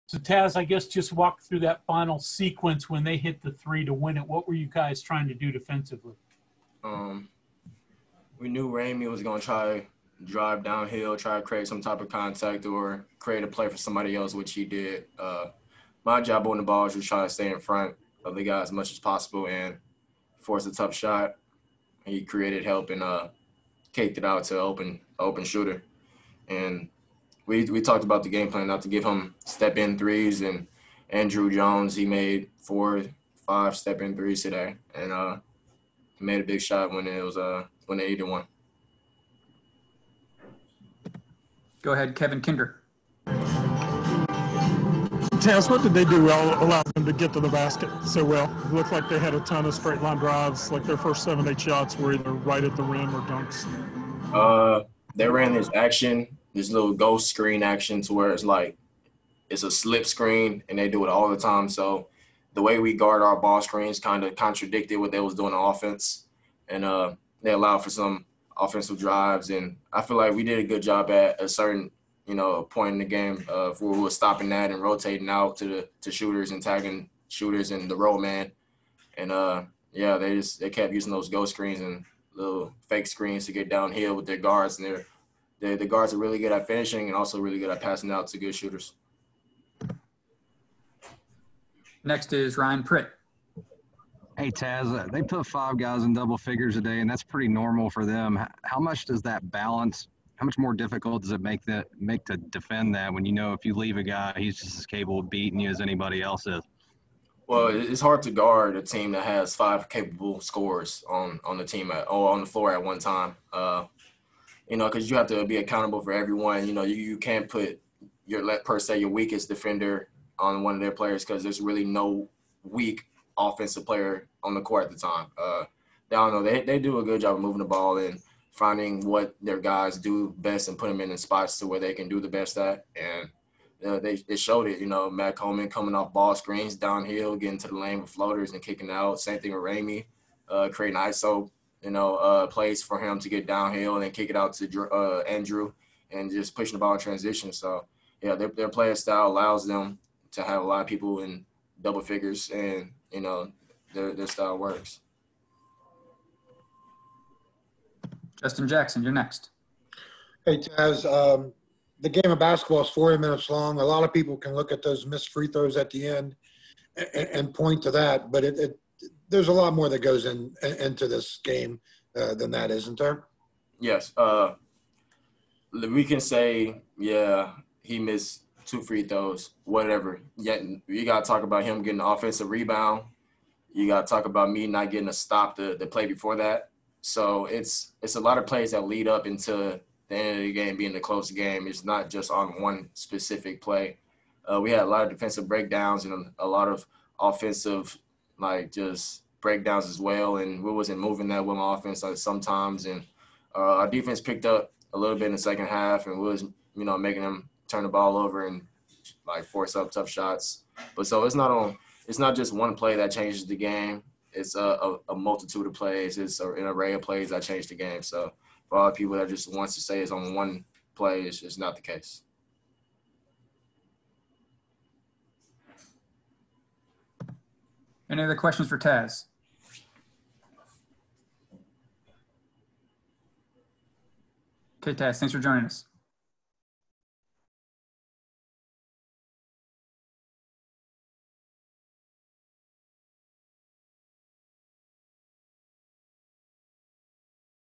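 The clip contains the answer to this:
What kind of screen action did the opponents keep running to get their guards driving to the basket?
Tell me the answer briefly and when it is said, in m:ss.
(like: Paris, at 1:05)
ghost screen, at 0:56.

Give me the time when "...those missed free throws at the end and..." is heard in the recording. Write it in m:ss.
2:44.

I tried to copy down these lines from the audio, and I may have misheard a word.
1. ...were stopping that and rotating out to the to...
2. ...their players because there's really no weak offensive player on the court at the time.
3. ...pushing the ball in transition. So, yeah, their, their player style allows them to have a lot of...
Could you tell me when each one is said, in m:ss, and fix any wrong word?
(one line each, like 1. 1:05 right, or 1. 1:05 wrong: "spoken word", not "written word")
1. 1:13 right
2. 2:00 right
3. 2:26 right.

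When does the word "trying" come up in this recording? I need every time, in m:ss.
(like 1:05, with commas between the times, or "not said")
0:05, 0:16.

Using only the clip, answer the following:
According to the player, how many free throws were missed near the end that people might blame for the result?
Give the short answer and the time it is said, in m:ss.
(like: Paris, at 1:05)
2, at 2:58.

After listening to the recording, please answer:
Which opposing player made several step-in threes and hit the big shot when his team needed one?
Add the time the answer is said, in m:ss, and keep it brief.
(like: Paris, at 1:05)
Andrew Jones, at 0:31.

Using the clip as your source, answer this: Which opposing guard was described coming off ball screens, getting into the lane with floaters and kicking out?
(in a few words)
Matt Coleman.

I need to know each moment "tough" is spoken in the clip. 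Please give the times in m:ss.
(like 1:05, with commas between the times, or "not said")
0:20, 3:29.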